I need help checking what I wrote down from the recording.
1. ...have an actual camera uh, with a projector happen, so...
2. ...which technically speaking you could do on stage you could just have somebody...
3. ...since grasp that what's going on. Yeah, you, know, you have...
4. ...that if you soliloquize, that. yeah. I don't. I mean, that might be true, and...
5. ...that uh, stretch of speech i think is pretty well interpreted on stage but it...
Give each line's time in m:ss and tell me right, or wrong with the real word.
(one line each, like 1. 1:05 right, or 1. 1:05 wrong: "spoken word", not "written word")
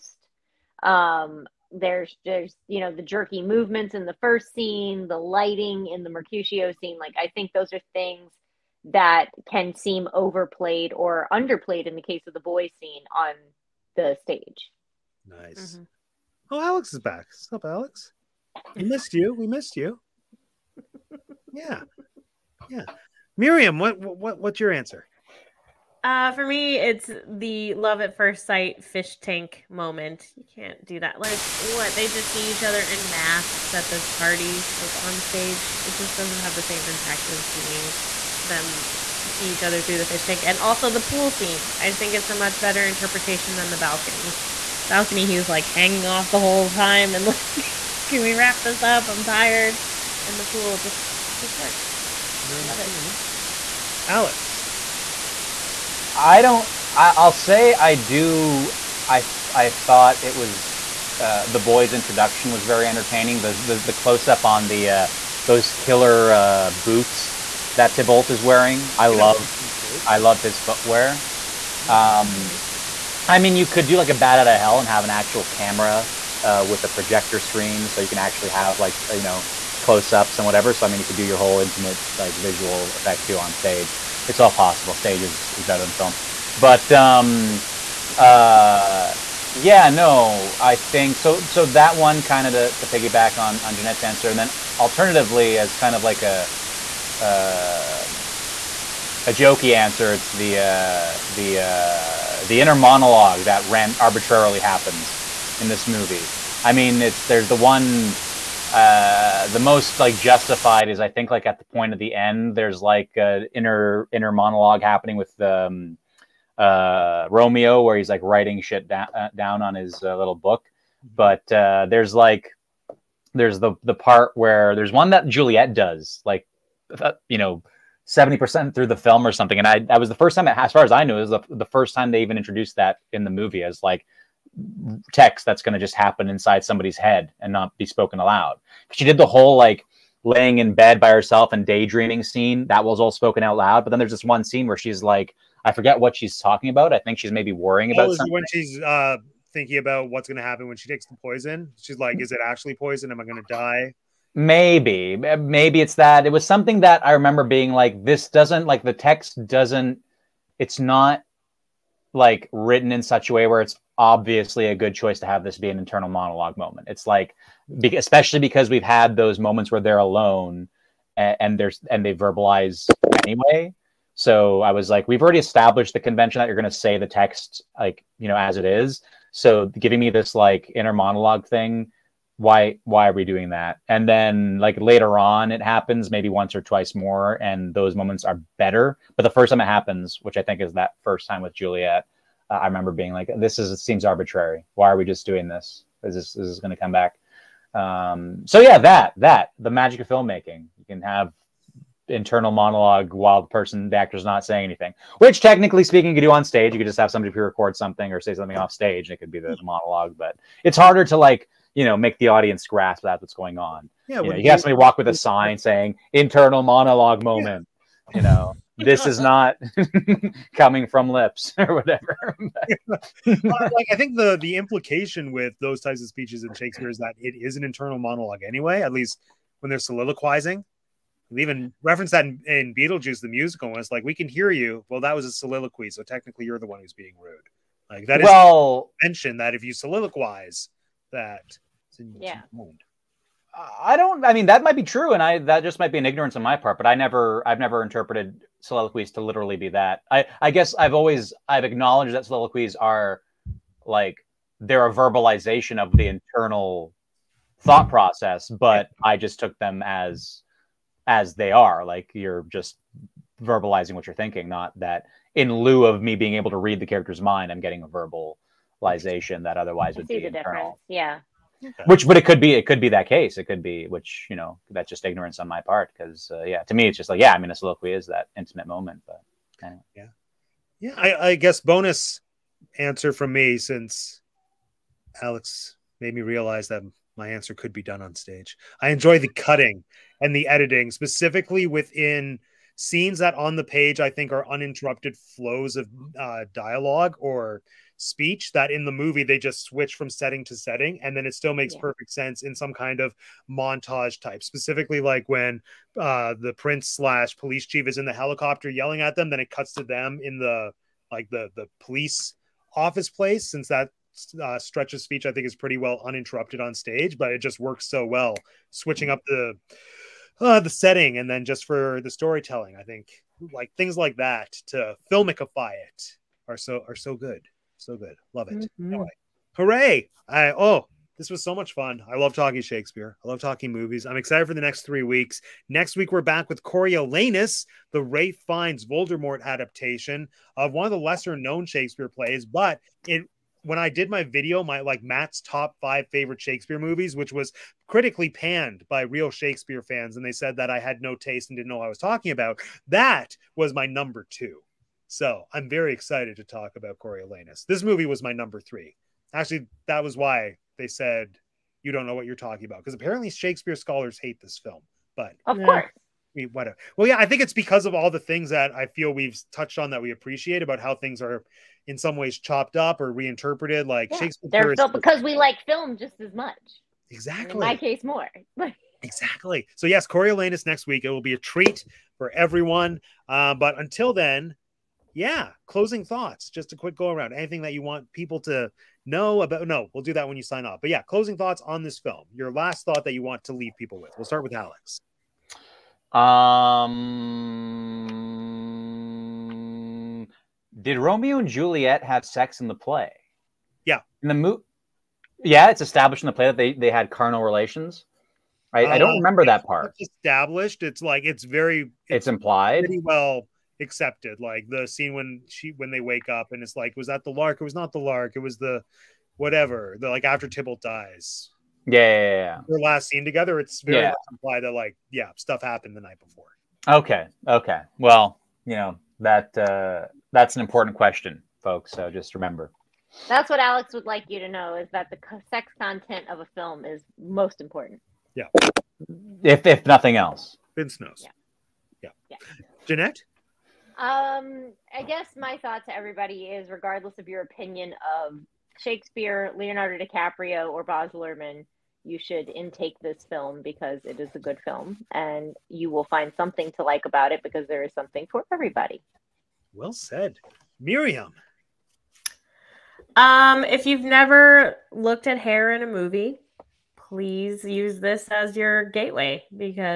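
1. 1:14 wrong: "screen", not "happen"
2. 3:25 right
3. 3:32 wrong: "audience", not "since"
4. 3:59 right
5. 5:13 wrong: "uninterrupted", not "interpreted".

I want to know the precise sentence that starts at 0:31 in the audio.
They just see each other in masks at this party, like on stage.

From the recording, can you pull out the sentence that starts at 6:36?
Um, did Romeo and Juliet have sex in the play?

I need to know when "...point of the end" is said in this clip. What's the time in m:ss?
1:51.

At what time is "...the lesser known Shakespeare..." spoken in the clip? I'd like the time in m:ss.
5:40.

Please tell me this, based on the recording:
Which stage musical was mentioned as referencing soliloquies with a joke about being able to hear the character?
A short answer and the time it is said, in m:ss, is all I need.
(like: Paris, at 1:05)
Beetlejuice, at 3:52.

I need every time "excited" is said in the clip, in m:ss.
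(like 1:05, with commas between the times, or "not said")
5:34, 5:55.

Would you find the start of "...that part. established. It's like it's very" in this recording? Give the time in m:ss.
6:49.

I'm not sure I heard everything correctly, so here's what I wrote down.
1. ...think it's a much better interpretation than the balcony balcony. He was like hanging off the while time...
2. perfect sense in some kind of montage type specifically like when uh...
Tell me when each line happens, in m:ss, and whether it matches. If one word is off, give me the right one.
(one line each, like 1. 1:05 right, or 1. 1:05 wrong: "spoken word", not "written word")
1. 0:41 wrong: "whole", not "while"
2. 5:01 right.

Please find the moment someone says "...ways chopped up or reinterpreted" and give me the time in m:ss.
6:12.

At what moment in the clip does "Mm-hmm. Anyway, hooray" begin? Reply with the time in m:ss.
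5:28.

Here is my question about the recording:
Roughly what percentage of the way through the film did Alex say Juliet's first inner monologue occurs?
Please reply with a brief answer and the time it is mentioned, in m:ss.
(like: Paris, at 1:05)
70%, at 2:08.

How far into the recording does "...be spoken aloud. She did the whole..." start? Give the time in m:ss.
2:17.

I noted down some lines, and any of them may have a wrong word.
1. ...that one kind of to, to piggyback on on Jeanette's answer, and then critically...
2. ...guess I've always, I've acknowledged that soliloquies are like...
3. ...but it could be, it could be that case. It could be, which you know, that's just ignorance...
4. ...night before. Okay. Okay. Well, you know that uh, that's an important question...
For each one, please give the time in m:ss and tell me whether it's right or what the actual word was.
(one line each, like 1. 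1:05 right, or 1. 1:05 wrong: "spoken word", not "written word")
1. 1:31 wrong: "alternatively", not "critically"
2. 4:10 right
3. 4:32 right
4. 7:06 right.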